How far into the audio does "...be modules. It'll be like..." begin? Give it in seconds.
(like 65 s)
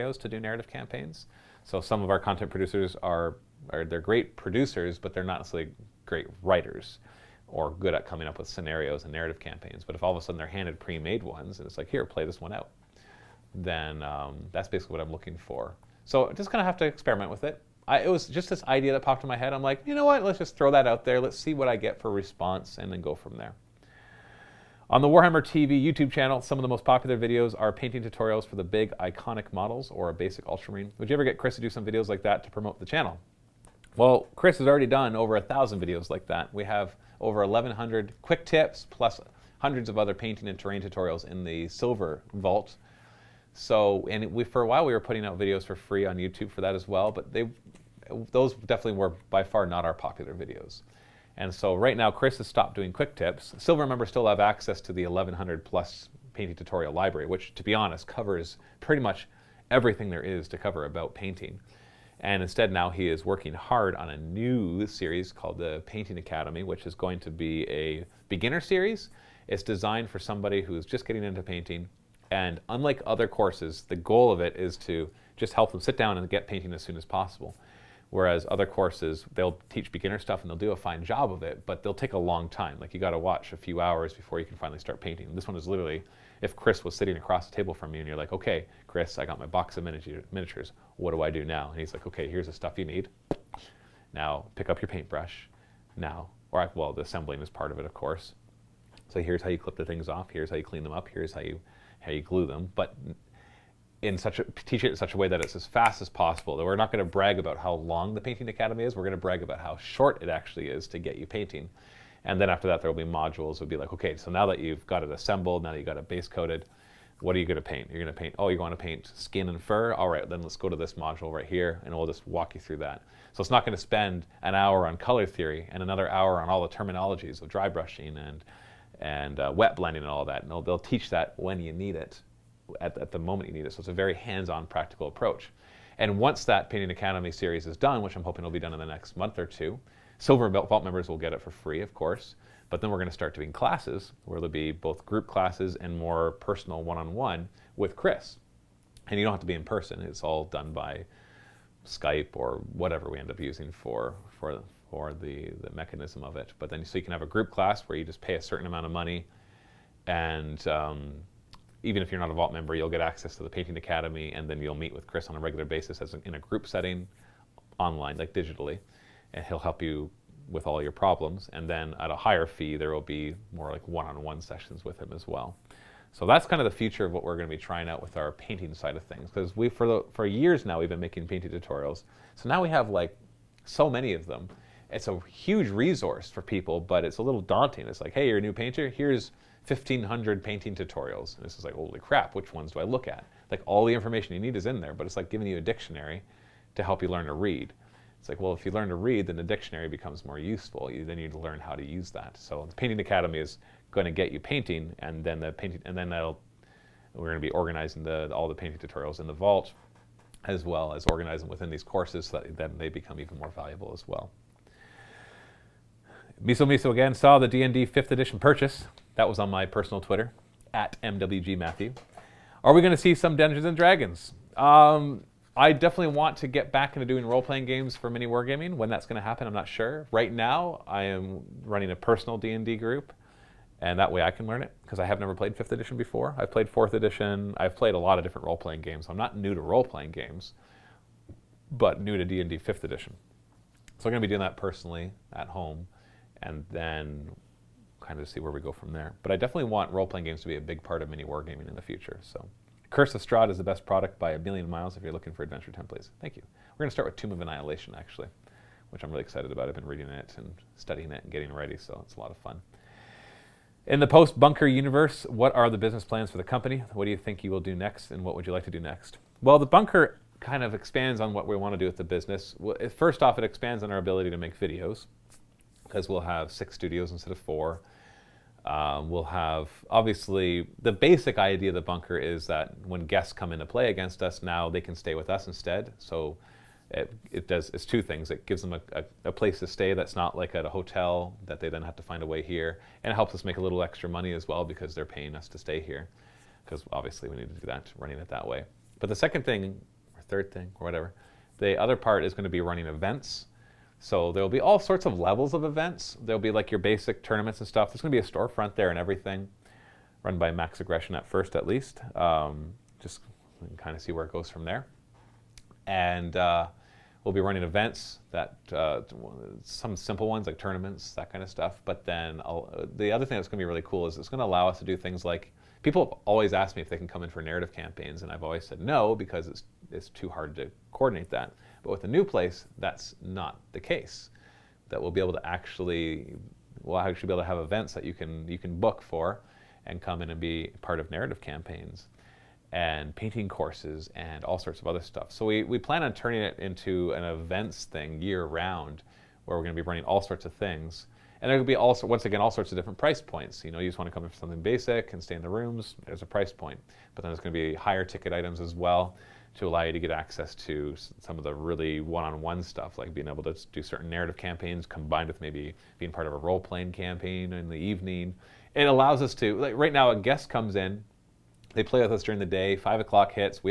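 113 s.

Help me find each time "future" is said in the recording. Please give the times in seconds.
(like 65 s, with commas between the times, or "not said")
176 s, 251 s.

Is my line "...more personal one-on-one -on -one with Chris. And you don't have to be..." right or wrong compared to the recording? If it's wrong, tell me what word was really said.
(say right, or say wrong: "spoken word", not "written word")
right.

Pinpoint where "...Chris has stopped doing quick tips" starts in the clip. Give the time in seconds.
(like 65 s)
52 s.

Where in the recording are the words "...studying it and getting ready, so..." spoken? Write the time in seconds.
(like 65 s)
260 s.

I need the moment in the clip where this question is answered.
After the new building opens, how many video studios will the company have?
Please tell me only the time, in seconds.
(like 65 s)
276 s.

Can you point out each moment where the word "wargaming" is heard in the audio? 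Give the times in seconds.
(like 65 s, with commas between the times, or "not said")
228 s, 251 s.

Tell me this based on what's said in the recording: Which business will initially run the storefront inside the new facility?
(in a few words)
Max Aggression.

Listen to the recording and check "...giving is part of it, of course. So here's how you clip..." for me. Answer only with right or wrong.
wrong.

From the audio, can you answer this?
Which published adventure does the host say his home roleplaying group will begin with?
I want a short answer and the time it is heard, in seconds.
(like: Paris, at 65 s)
Tomb of Annihilation, at 257 s.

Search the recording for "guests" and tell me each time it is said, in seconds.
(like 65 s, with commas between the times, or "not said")
283 s, 370 s.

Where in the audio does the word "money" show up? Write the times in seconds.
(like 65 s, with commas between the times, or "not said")
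158 s, 294 s.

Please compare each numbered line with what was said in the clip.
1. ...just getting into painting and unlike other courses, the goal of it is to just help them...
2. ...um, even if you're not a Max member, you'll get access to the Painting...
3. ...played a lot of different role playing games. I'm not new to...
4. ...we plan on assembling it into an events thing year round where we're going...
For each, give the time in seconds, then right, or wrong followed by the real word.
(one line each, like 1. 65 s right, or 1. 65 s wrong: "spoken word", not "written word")
1. 70 s right
2. 160 s wrong: "Vault", not "Max"
3. 237 s right
4. 345 s wrong: "turning", not "assembling".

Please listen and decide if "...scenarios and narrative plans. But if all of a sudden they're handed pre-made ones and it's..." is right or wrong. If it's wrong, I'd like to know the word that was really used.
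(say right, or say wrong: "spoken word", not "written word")
wrong: "campaigns", not "plans".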